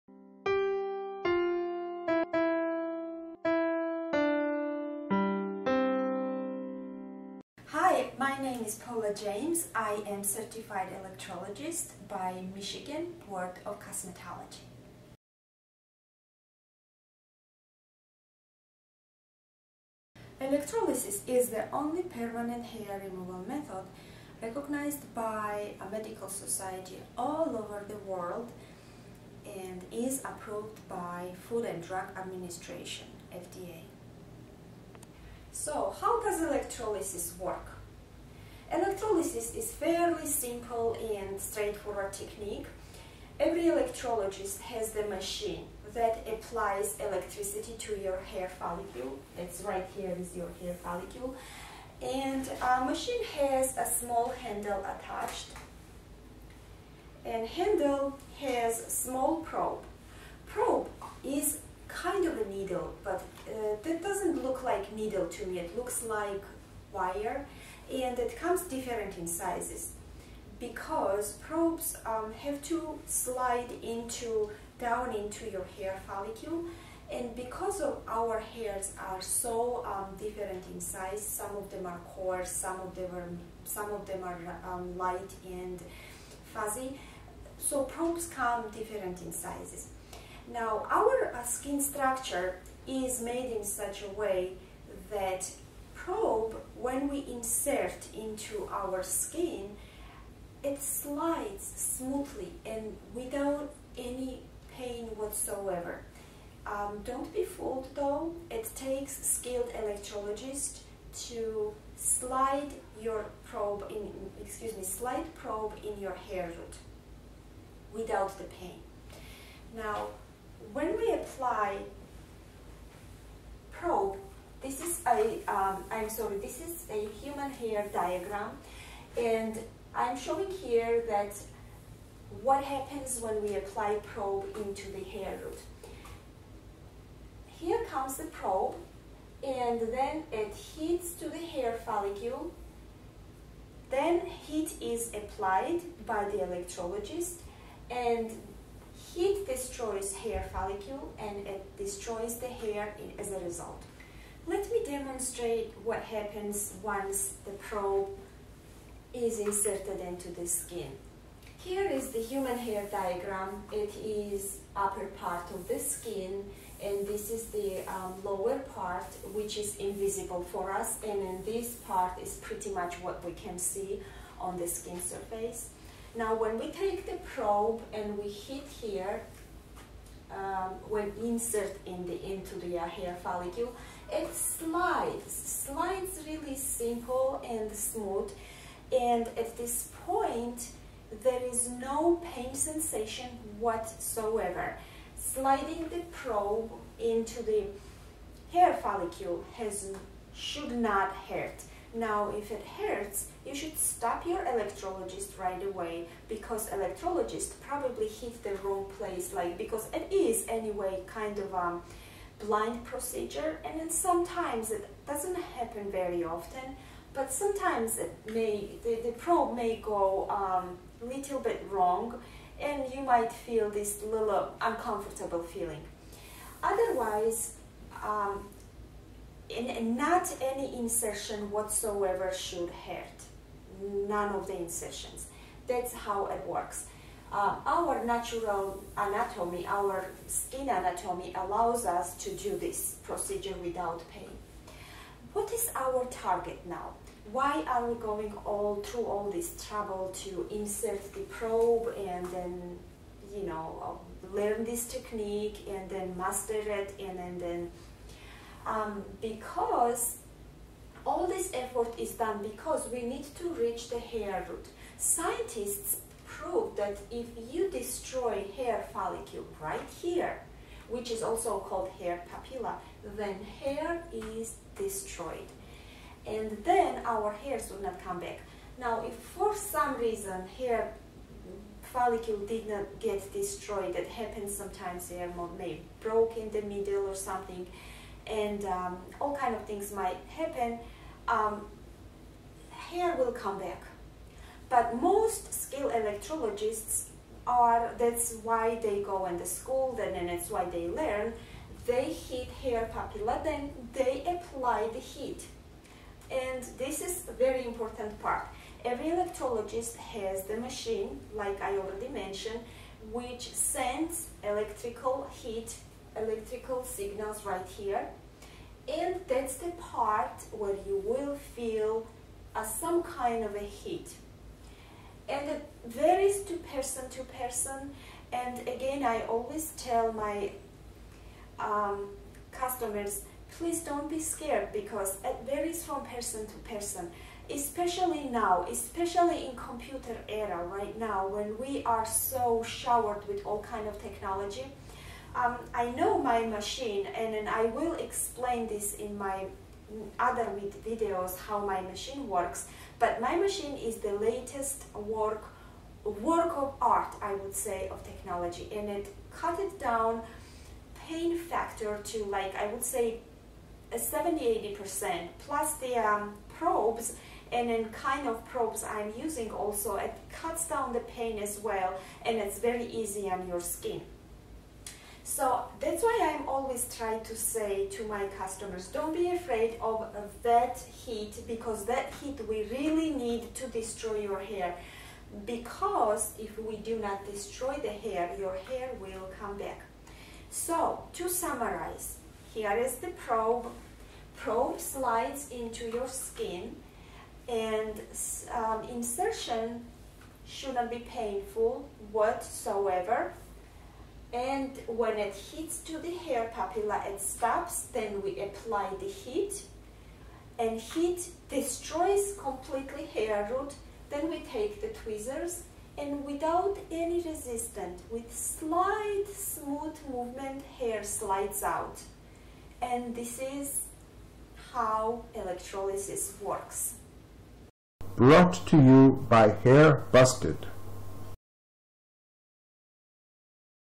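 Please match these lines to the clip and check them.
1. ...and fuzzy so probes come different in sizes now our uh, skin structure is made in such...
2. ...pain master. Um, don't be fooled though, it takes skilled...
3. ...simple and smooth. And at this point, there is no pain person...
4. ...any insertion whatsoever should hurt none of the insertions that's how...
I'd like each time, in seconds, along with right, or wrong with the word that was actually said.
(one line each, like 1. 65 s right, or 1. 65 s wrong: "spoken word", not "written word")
1. 85 s right
2. 104 s wrong: "whatsoever", not "master"
3. 186 s wrong: "sensation", not "person"
4. 230 s right.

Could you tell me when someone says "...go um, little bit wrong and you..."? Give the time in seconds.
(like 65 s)
219 s.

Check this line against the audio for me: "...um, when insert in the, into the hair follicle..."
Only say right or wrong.
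right.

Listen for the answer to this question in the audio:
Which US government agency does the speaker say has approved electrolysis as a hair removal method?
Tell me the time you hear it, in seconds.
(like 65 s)
31 s.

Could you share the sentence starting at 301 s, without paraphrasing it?
They heat hair papilla, then they apply the heat.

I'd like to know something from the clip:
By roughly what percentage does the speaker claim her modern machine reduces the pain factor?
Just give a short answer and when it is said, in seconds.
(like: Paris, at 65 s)
70-80%, at 363 s.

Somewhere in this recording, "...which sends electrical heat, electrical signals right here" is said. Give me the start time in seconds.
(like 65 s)
313 s.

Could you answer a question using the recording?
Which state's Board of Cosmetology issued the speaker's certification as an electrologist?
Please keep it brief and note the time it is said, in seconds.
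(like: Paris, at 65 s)
Michigan, at 12 s.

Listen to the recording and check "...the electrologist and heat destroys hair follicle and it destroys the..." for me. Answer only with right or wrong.
right.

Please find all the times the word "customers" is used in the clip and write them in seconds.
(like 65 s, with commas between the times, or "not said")
332 s, 378 s.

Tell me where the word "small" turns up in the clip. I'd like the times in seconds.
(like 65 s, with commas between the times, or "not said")
53 s, 58 s.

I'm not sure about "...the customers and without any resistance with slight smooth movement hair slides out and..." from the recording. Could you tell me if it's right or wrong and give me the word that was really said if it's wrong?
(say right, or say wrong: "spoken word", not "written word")
wrong: "tweezers", not "customers".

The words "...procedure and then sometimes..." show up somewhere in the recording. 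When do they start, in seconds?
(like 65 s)
212 s.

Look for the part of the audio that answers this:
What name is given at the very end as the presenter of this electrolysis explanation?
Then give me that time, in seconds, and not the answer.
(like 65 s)
429 s.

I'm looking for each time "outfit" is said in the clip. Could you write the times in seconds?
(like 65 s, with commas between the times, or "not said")
not said.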